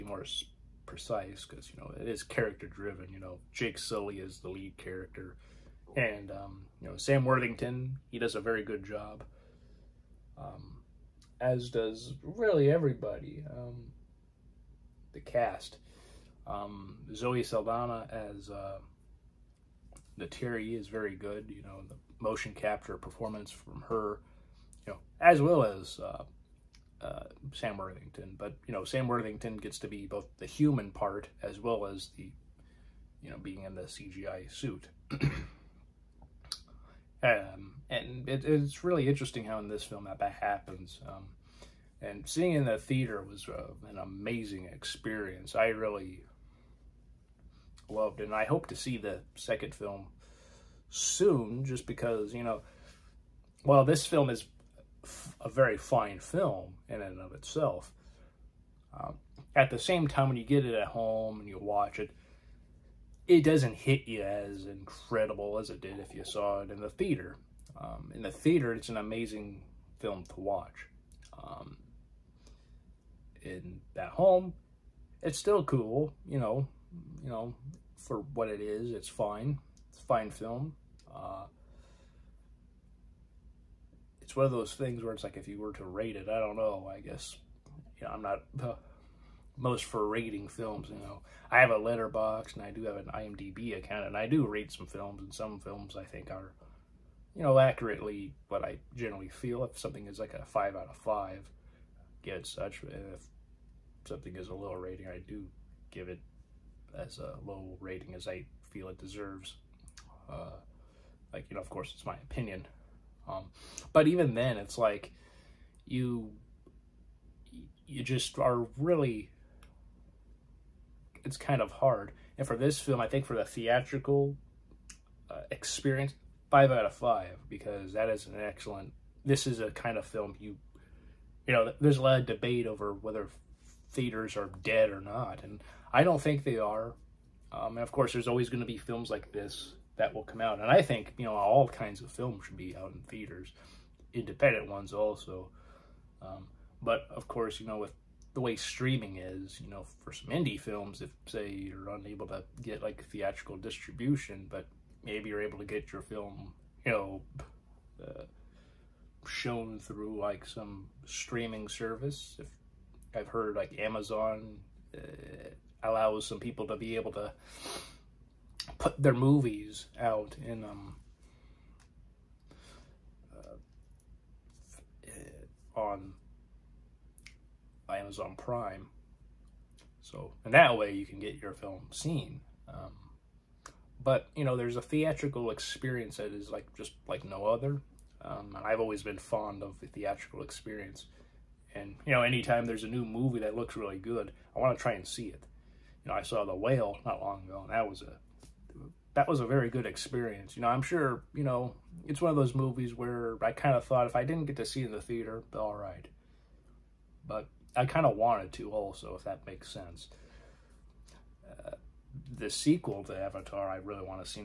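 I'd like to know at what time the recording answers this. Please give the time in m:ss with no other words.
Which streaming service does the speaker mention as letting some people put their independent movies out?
2:57.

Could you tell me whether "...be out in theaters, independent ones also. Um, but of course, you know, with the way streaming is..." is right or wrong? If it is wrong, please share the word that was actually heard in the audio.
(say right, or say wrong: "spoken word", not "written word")
right.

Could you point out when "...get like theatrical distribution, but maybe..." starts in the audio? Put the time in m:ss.
2:32.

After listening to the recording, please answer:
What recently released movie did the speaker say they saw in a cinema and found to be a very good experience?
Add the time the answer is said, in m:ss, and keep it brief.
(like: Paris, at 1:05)
The Whale, at 3:16.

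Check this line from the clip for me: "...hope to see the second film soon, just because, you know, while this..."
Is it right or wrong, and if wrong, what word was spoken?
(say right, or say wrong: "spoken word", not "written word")
right.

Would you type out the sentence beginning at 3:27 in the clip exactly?
But I kind of wanted to also, if that makes sense.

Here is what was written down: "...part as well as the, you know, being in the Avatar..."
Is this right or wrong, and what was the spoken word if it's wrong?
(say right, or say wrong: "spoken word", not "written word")
wrong: "CGI", not "Avatar".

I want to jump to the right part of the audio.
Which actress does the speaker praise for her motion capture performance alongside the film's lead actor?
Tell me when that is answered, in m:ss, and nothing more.
0:17.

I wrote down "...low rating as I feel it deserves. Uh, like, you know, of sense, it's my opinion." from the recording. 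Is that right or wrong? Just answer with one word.
wrong.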